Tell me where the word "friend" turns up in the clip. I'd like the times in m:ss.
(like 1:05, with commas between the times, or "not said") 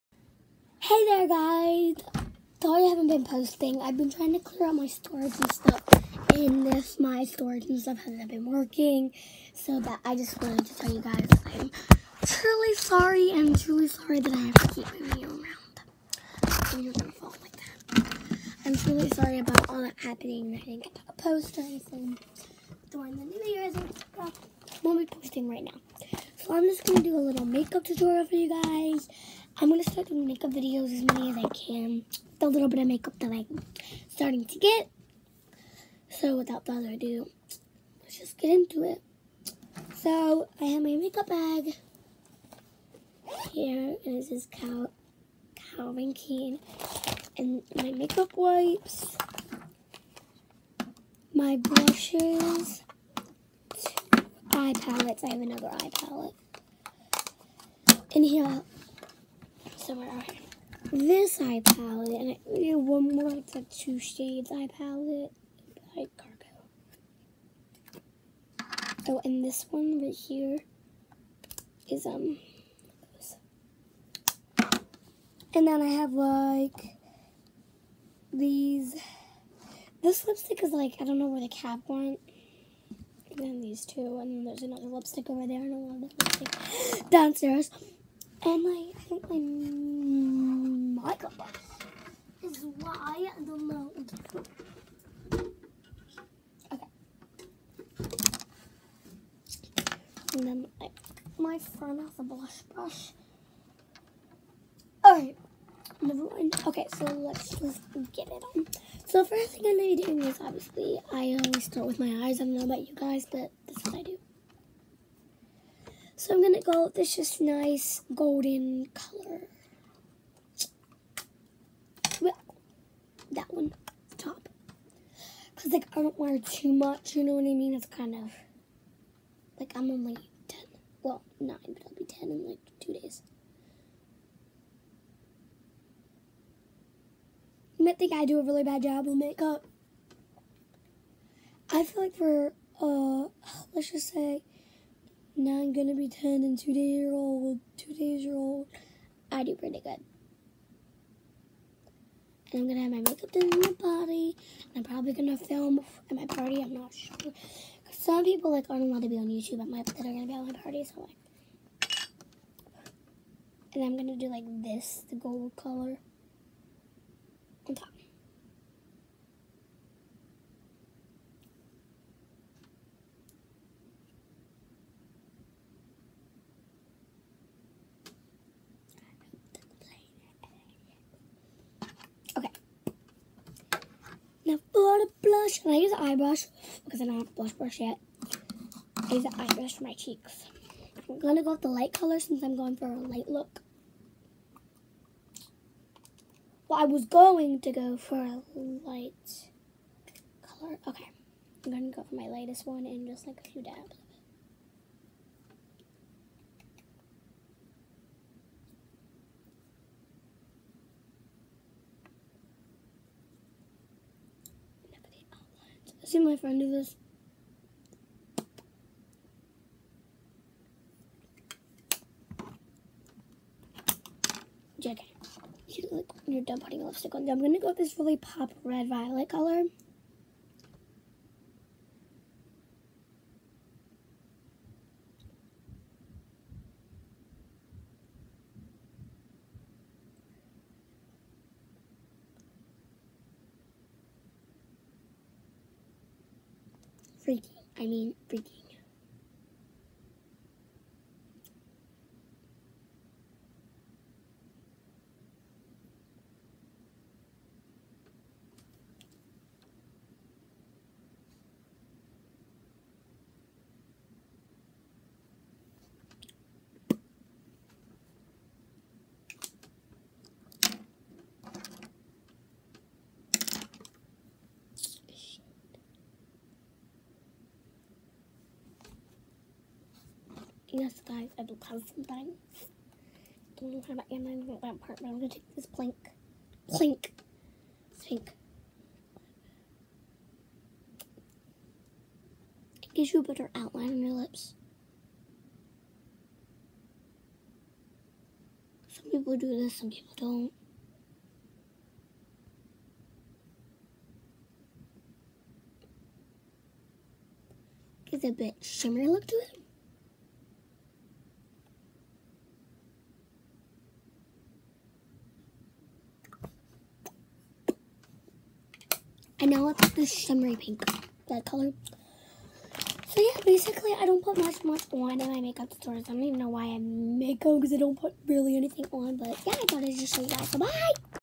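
1:41, 3:36.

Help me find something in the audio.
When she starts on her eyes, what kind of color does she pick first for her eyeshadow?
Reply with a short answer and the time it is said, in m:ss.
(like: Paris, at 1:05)
Golden, at 1:58.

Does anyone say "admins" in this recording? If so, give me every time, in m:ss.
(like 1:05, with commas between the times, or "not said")
not said.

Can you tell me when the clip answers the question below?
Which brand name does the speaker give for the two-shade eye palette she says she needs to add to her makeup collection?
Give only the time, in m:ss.
1:06.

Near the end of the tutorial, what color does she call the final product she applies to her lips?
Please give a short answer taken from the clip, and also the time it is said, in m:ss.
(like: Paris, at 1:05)
Shimmery pink, at 5:20.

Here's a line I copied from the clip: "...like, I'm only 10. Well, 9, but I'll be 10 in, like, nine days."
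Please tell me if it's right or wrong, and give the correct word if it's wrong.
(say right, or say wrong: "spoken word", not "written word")
wrong: "two", not "nine".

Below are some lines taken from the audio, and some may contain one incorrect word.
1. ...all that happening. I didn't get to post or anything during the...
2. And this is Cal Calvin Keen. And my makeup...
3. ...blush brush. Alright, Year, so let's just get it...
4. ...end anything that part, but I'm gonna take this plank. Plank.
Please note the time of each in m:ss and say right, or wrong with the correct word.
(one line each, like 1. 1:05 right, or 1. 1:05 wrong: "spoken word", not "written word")
1. 0:19 right
2. 0:44 right
3. 1:42 wrong: "Okay", not "Year"
4. 4:44 right.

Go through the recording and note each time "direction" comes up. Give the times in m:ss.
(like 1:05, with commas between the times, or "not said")
not said.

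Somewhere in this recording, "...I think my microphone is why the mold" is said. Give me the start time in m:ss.
1:28.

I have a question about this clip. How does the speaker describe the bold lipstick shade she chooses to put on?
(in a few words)
Pop red violet.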